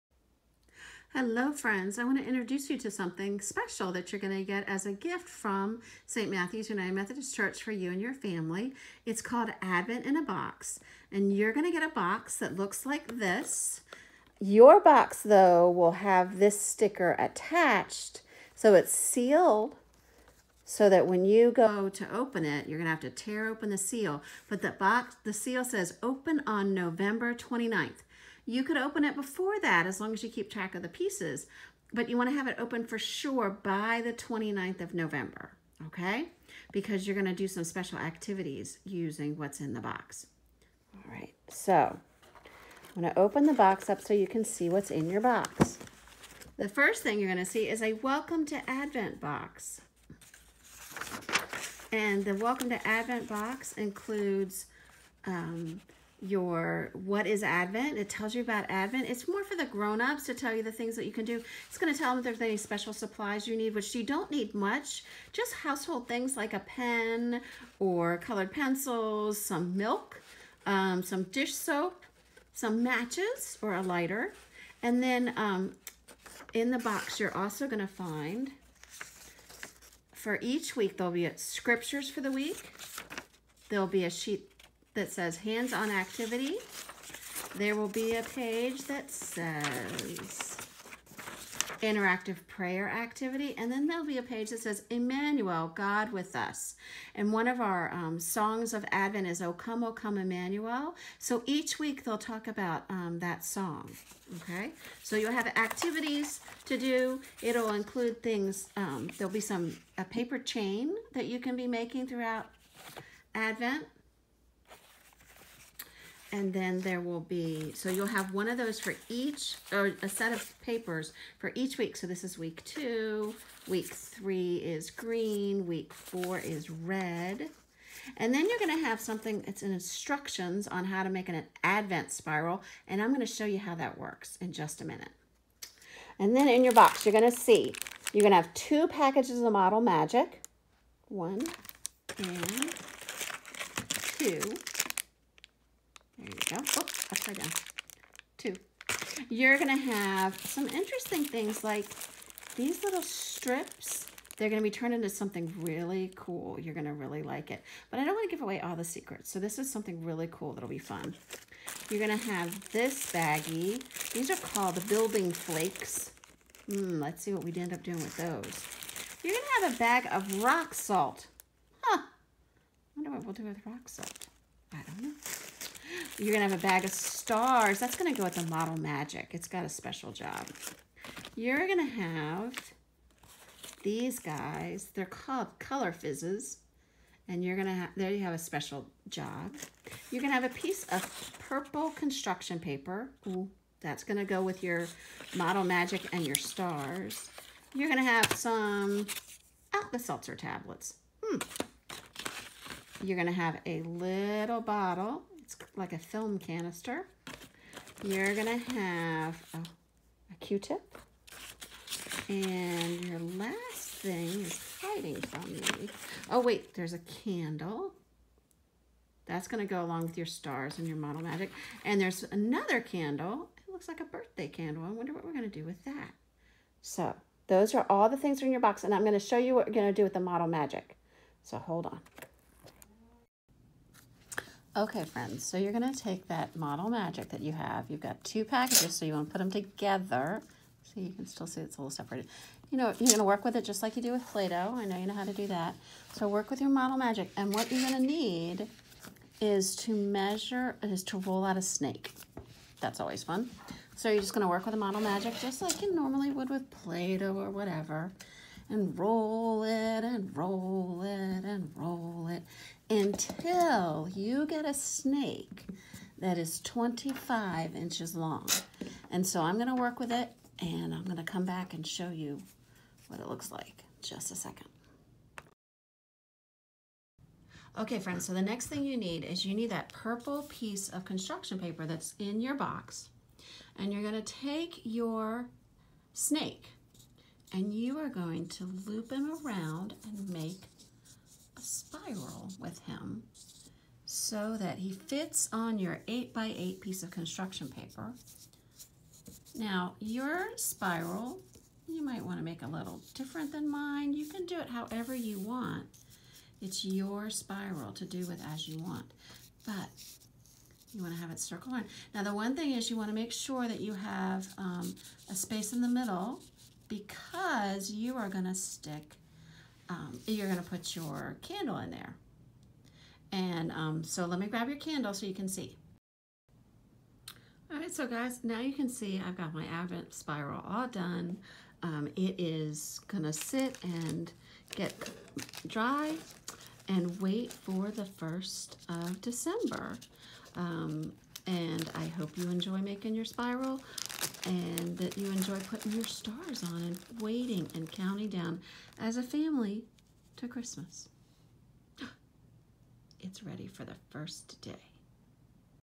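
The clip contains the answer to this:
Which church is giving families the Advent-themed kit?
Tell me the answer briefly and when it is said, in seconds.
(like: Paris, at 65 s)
St. Matthew's United Methodist Church, at 6 s.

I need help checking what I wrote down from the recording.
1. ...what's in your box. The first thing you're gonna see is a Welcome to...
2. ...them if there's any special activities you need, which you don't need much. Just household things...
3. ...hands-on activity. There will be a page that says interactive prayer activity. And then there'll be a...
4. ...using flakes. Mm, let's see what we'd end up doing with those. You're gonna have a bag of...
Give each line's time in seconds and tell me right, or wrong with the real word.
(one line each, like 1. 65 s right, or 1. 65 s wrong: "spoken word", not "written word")
1. 44 s right
2. 62 s wrong: "supplies", not "activities"
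3. 85 s right
4. 164 s wrong: "building", not "using".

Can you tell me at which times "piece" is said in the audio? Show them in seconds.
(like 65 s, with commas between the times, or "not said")
30 s, 190 s, 280 s, 296 s.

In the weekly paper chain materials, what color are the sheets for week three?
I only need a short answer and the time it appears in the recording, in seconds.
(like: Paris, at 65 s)
green, at 124 s.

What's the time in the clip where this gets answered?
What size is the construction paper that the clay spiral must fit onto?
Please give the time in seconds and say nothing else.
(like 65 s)
296 s.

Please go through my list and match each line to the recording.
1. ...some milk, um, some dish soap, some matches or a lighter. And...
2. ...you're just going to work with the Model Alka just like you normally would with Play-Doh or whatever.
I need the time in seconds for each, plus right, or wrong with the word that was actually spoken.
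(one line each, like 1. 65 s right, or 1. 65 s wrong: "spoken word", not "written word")
1. 69 s right
2. 254 s wrong: "Magic", not "Alka".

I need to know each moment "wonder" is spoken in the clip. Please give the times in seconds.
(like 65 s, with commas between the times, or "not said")
172 s, 224 s.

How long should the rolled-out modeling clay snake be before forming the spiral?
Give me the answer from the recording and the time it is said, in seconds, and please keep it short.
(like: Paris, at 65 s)
25 inches, at 266 s.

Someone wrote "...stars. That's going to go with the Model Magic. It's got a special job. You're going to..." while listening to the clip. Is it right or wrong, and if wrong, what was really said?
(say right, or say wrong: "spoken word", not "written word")
right.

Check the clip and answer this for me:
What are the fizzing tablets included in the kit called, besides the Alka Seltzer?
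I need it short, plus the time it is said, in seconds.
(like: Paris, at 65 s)
Color Fizzes, at 185 s.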